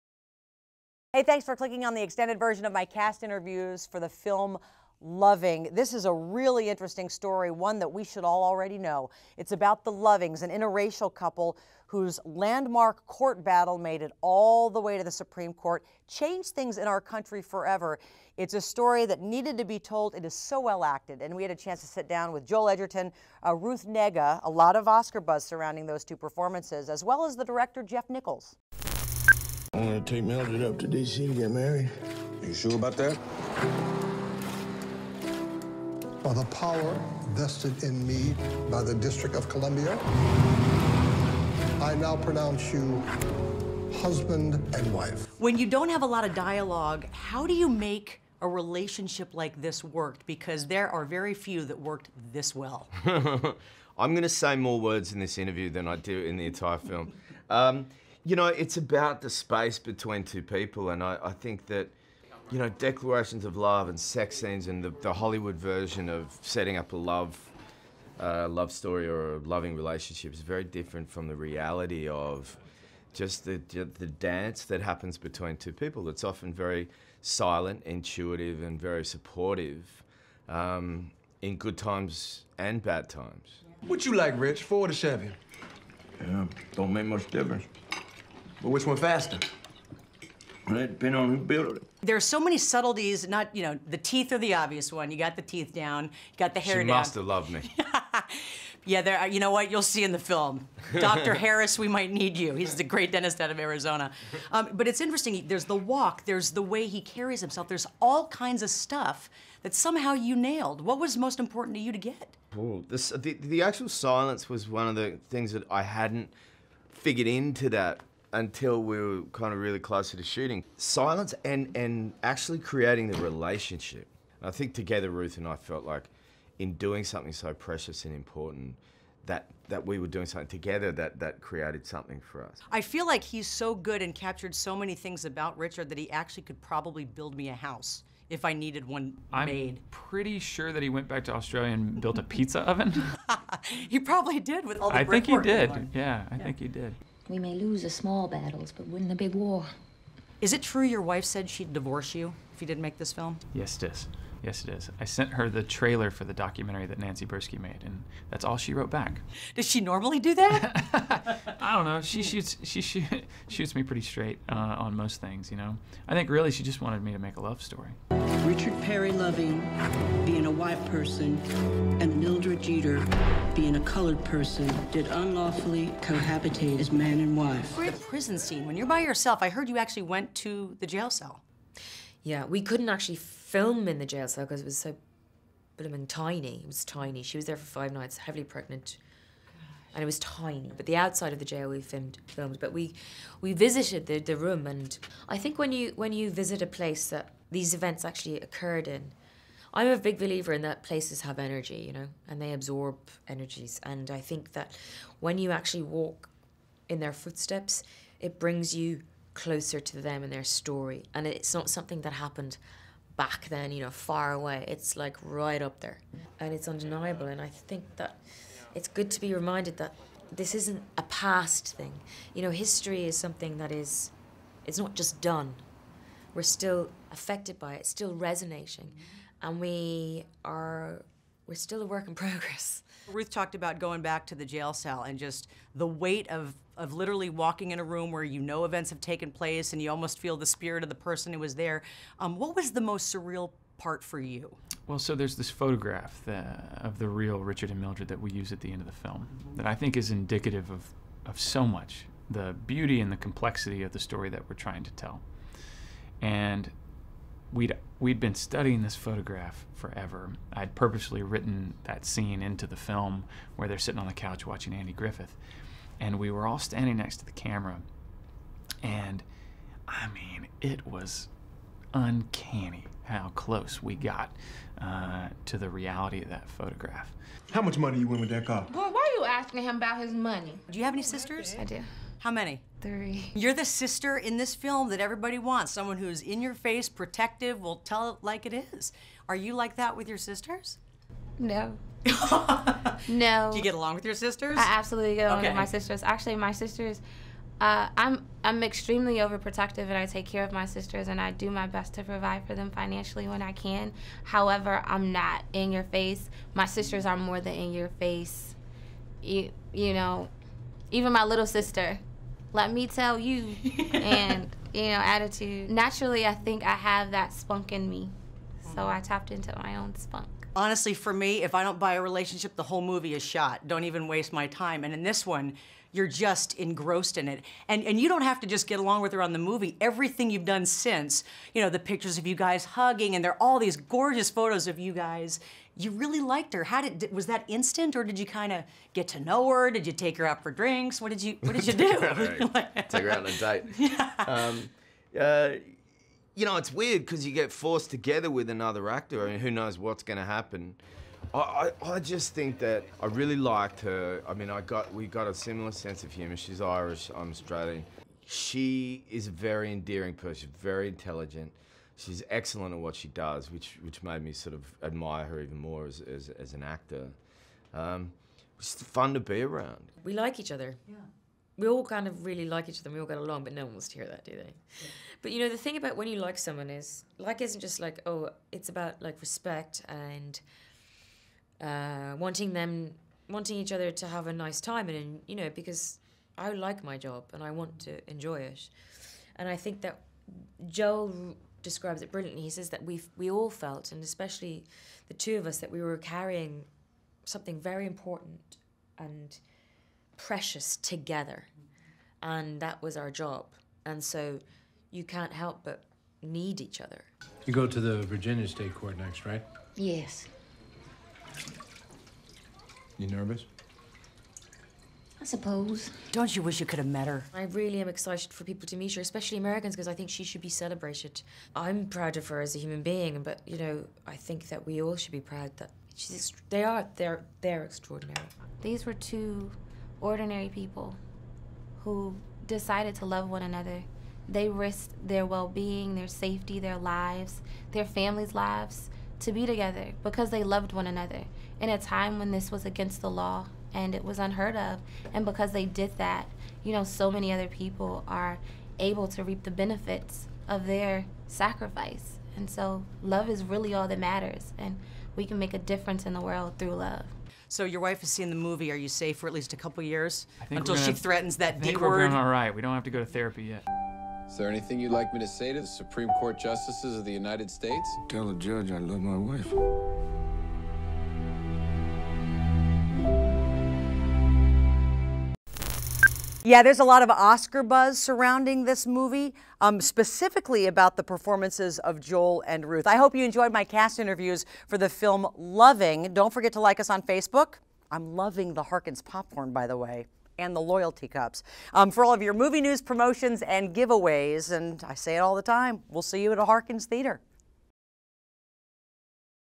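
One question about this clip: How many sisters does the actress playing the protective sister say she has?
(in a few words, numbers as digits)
3.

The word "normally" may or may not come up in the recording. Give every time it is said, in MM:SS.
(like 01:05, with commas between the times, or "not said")
02:39.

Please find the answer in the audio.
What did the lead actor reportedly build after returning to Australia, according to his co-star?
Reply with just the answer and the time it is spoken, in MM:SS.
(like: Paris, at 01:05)
A pizza oven, at 02:22.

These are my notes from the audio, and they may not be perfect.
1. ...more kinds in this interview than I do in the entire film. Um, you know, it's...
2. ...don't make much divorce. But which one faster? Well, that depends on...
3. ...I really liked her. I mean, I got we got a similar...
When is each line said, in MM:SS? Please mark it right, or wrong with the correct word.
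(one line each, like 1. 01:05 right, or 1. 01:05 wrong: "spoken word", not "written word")
1. 00:54 wrong: "words", not "kinds"
2. 01:26 wrong: "difference", not "divorce"
3. 05:53 right.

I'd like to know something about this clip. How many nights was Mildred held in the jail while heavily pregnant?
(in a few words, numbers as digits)
5.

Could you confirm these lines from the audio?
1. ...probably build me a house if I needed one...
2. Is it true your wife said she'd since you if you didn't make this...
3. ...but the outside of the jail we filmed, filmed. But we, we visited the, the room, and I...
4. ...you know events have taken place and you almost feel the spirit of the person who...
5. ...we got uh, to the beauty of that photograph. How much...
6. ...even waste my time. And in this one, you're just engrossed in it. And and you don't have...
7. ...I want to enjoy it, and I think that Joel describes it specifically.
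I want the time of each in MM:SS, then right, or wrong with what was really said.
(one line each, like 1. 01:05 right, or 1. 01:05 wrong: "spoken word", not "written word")
1. 02:16 right
2. 02:30 wrong: "divorce", not "since"
3. 03:10 right
4. 03:58 right
5. 04:33 wrong: "reality", not "beauty"
6. 05:23 right
7. 06:27 wrong: "brilliantly", not "specifically".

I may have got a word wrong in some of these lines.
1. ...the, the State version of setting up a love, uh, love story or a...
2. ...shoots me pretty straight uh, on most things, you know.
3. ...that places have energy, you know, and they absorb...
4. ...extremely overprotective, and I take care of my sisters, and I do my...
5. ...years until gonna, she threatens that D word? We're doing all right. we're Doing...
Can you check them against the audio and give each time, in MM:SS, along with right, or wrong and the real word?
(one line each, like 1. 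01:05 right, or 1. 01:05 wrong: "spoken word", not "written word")
1. 01:04 wrong: "Hollywood", not "State"
2. 02:43 right
3. 03:20 right
4. 04:58 right
5. 07:39 right.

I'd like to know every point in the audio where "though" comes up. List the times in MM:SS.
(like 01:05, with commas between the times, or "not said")
not said.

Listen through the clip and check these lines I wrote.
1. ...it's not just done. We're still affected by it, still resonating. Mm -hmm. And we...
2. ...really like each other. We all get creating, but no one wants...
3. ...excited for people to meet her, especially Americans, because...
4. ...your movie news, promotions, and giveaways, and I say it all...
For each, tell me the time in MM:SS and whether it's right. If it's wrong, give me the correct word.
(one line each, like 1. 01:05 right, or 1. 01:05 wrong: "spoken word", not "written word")
1. 03:44 right
2. 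06:12 wrong: "along", not "creating"
3. 06:57 right
4. 08:12 right.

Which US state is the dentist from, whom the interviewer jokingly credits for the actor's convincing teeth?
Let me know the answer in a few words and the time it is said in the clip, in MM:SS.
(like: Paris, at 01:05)
Arizona, at 01:43.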